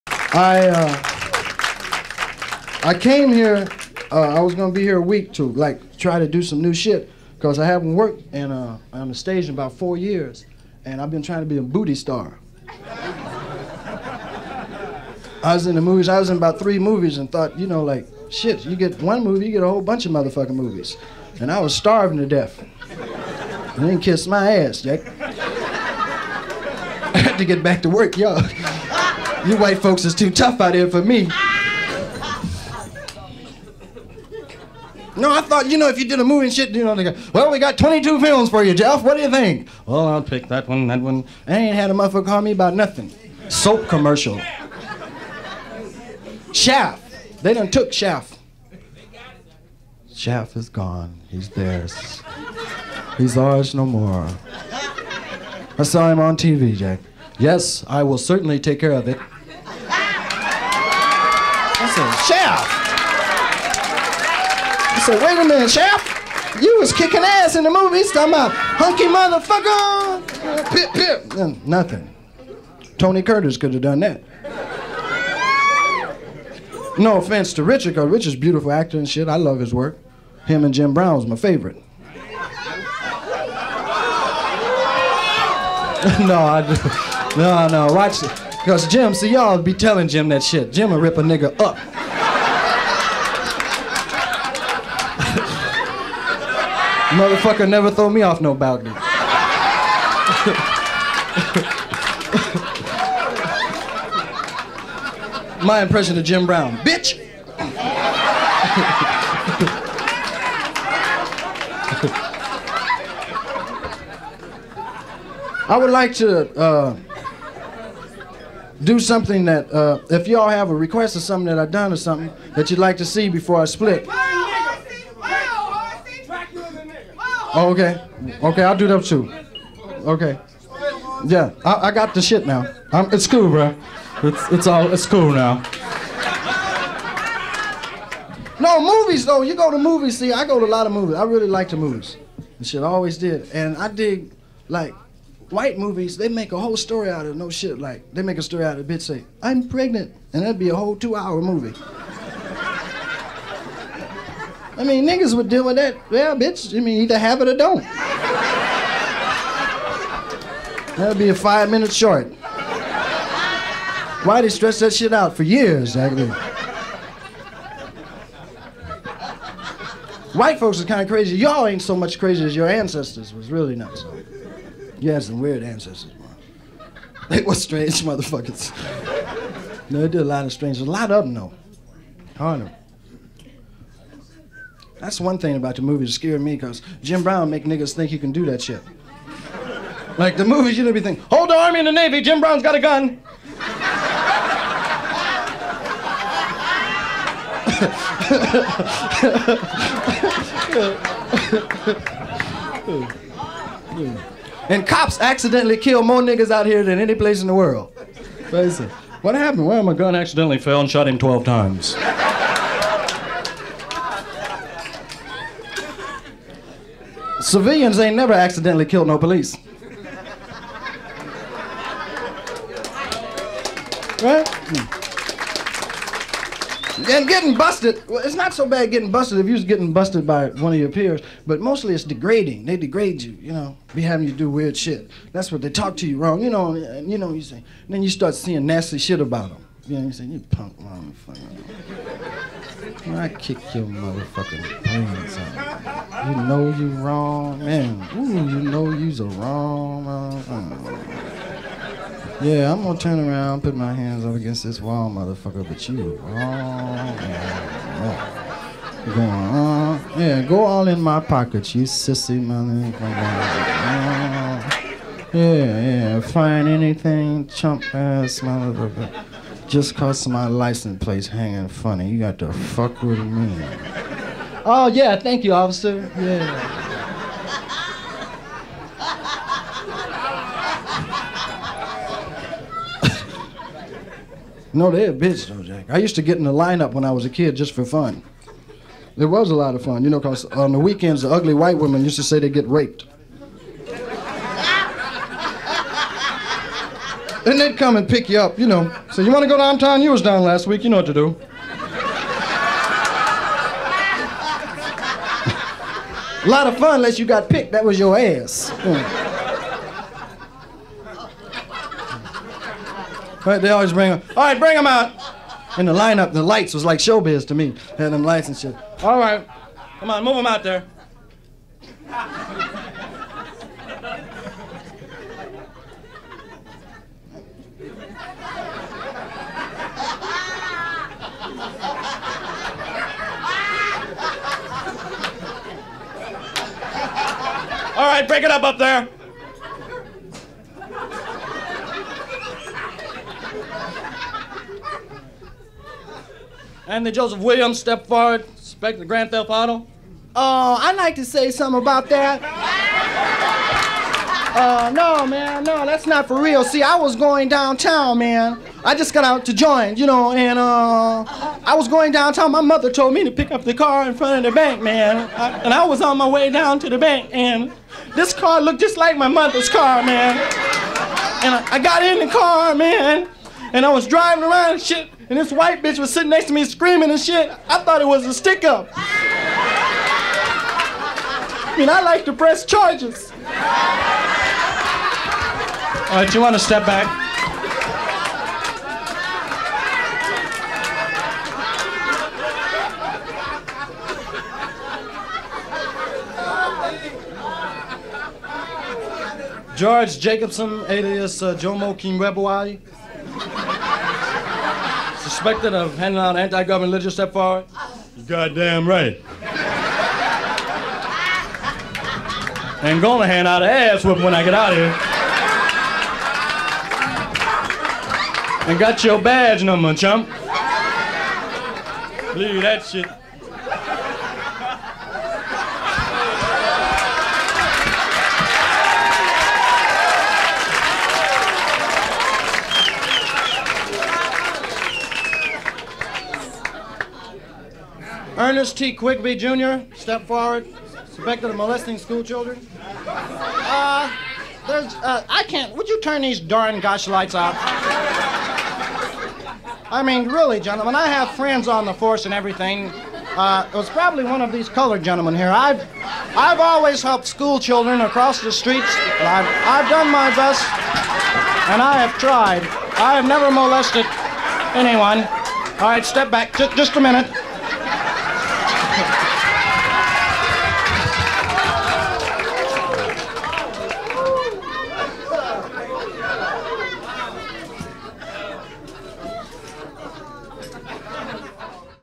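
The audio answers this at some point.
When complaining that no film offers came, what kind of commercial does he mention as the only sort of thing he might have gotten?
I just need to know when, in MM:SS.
00:43.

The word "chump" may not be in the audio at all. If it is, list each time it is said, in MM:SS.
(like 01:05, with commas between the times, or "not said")
04:27, 06:59.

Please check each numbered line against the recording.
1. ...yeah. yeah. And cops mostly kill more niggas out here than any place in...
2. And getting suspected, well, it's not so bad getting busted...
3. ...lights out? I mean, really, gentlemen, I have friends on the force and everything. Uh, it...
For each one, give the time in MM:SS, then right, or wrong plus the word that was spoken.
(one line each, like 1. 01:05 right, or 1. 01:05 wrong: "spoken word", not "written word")
1. 03:23 wrong: "accidentally", not "mostly"
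2. 03:46 wrong: "busted", not "suspected"
3. 07:27 right.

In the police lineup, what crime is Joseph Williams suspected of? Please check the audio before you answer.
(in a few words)
Grand Theft Auto.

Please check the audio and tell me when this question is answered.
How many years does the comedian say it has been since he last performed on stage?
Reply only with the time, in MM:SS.
00:09.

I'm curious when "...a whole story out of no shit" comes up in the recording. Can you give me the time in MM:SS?
02:26.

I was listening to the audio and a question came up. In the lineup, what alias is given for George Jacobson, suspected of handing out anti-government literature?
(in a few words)
Jomo Kimbebwai.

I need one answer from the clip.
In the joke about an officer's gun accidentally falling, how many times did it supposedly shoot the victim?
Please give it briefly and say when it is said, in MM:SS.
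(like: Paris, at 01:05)
12, at 03:31.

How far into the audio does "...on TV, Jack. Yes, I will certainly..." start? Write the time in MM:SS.
00:56.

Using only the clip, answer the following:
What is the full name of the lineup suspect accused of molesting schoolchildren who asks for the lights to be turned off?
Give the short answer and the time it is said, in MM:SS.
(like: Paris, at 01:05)
Ernest T. Quigby Jr., at 07:18.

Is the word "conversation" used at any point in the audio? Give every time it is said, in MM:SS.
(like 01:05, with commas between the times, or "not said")
not said.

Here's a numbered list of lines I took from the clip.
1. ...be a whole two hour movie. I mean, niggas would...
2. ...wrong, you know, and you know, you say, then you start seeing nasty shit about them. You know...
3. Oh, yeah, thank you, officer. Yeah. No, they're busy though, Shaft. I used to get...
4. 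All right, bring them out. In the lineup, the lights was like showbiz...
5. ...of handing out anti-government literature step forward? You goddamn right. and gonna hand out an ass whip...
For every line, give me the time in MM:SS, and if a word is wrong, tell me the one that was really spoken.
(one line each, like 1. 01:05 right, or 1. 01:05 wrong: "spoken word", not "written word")
1. 02:30 right
2. 03:56 right
3. 04:34 wrong: "Jack", not "Shaft"
4. 05:14 right
5. 06:45 right.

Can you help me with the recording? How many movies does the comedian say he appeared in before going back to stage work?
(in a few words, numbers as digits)
3.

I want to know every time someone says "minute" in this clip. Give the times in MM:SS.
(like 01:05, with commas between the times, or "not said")
01:05, 02:41, 07:47.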